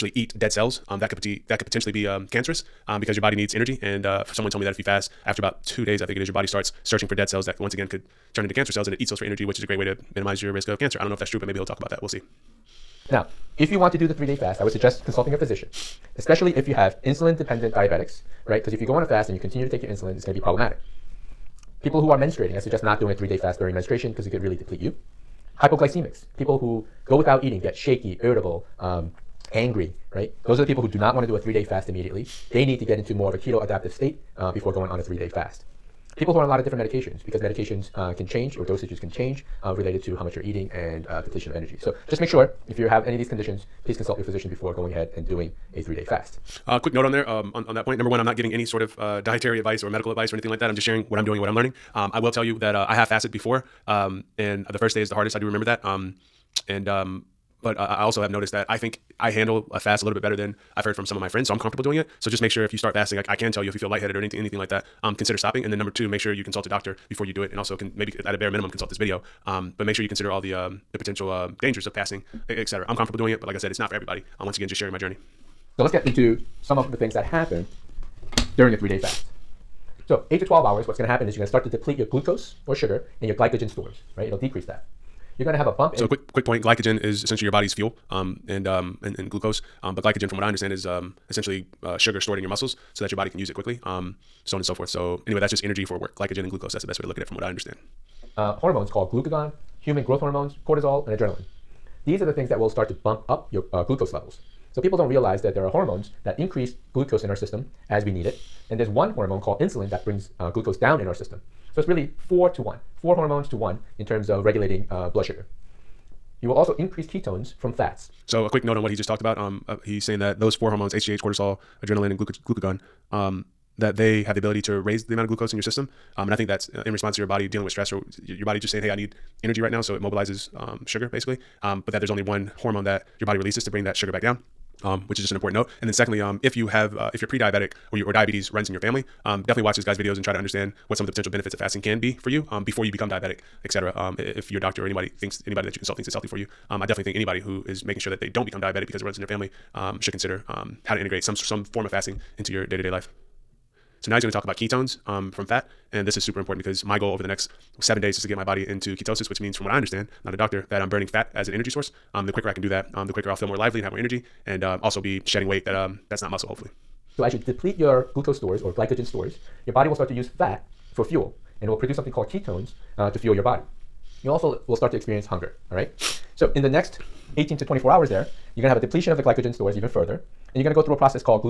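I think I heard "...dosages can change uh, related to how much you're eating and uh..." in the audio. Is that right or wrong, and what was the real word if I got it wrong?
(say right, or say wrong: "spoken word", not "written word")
right.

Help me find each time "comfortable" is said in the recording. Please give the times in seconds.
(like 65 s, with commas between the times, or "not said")
61 s, 72 s.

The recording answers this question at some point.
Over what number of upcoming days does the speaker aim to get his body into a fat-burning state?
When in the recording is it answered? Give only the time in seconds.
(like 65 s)
157 s.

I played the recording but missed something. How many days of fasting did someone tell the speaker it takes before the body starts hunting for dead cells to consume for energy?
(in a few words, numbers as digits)
2 days.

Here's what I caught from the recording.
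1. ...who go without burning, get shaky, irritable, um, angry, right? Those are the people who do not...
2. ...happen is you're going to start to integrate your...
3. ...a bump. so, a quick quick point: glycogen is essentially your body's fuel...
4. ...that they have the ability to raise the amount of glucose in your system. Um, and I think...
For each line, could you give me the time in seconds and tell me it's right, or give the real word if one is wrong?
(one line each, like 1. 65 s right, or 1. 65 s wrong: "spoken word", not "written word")
1. 26 s wrong: "eating", not "burning"
2. 81 s wrong: "deplete", not "integrate"
3. 85 s right
4. 123 s right.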